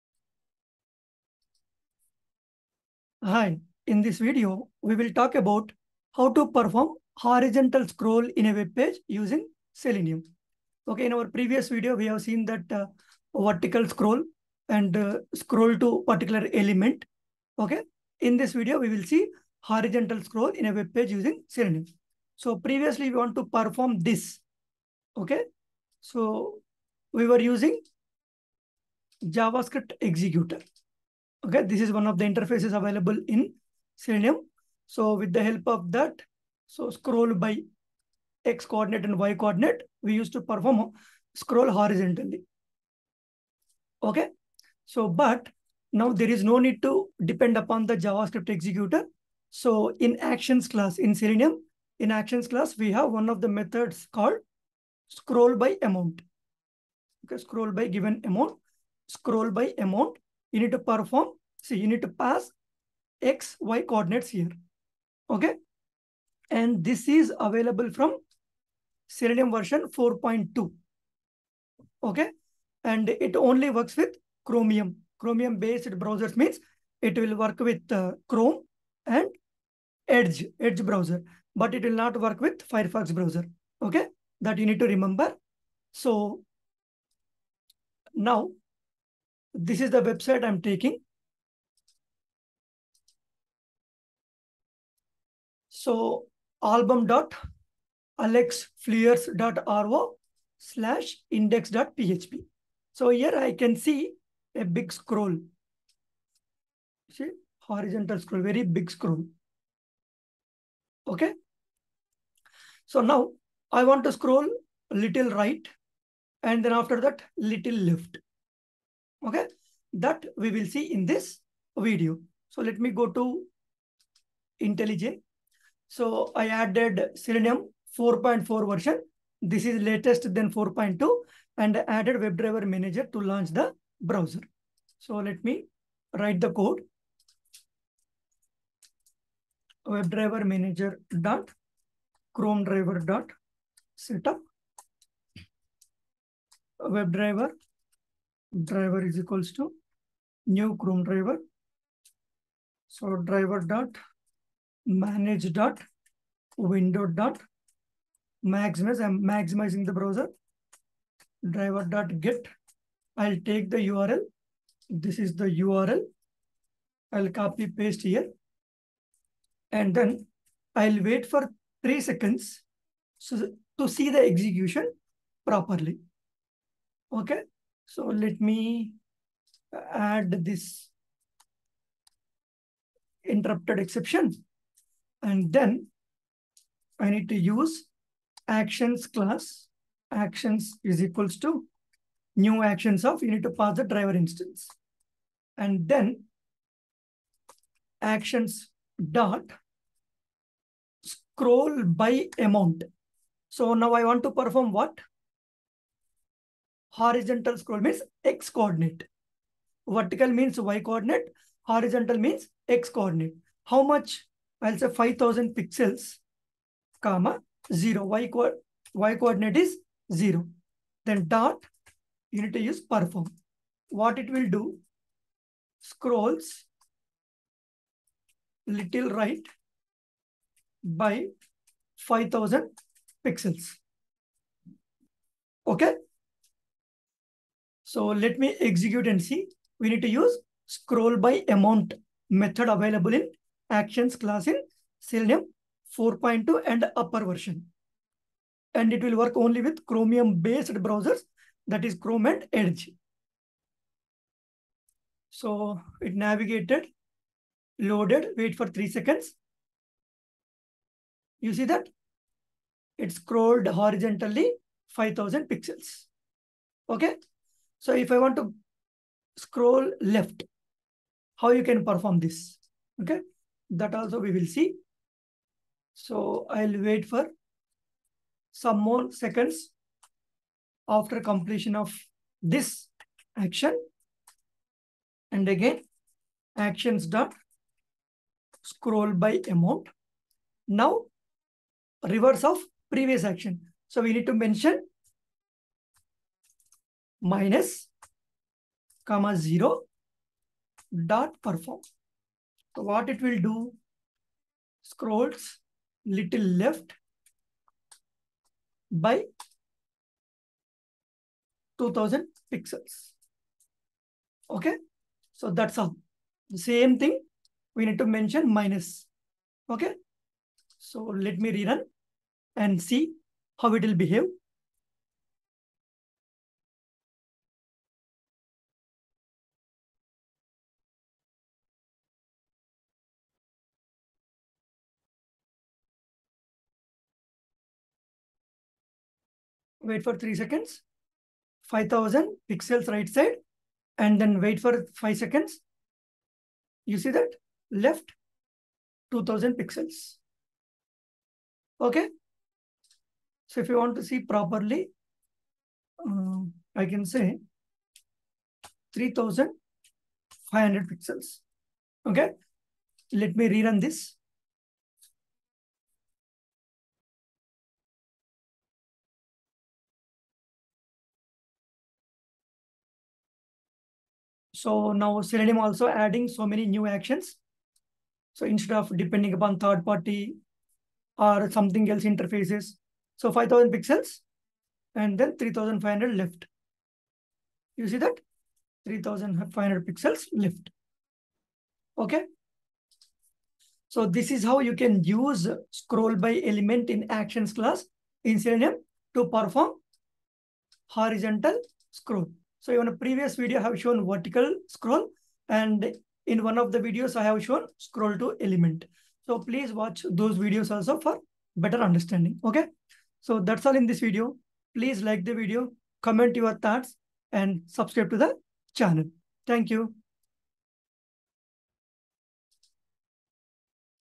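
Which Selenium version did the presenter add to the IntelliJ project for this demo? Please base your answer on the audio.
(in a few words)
4.4.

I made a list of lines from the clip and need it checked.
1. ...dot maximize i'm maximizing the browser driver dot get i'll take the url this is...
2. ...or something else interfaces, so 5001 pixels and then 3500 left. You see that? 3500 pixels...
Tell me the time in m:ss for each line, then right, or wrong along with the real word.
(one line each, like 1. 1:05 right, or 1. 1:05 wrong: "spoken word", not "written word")
1. 2:37 right
2. 6:21 wrong: "5000", not "5001".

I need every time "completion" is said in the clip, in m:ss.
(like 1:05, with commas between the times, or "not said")
4:41.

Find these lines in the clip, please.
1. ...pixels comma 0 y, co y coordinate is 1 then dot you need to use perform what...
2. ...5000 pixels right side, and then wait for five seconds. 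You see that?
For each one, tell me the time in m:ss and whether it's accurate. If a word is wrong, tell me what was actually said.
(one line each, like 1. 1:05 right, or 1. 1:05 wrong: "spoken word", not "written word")
1. 3:35 wrong: "0", not "1"
2. 5:41 right.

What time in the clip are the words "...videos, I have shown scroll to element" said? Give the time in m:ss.
6:46.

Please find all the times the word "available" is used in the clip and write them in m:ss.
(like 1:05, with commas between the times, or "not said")
0:32, 1:07, 4:02.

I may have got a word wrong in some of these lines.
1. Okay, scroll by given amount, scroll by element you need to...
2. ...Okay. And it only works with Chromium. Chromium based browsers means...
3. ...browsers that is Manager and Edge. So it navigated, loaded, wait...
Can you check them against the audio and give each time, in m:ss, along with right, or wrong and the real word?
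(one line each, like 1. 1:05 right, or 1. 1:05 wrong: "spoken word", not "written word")
1. 0:57 wrong: "amount", not "element"
2. 1:12 right
3. 4:10 wrong: "Chrome", not "Manager".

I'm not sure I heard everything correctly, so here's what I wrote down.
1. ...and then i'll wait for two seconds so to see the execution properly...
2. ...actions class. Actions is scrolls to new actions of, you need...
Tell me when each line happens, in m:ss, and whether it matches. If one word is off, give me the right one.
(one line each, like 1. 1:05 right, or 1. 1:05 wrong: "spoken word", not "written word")
1. 2:49 wrong: "three", not "two"
2. 3:08 wrong: "equals", not "scrolls".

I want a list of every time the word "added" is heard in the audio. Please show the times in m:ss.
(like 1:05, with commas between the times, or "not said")
2:06, 2:11.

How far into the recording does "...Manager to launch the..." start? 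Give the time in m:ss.
2:12.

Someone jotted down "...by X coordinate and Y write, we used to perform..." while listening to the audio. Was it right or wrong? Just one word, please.
wrong.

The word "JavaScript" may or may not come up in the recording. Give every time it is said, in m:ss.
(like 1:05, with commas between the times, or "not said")
0:29, 0:47.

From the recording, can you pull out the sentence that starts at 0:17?
Okay, in this video, we will see horizontal scroll in a web page using Selenium.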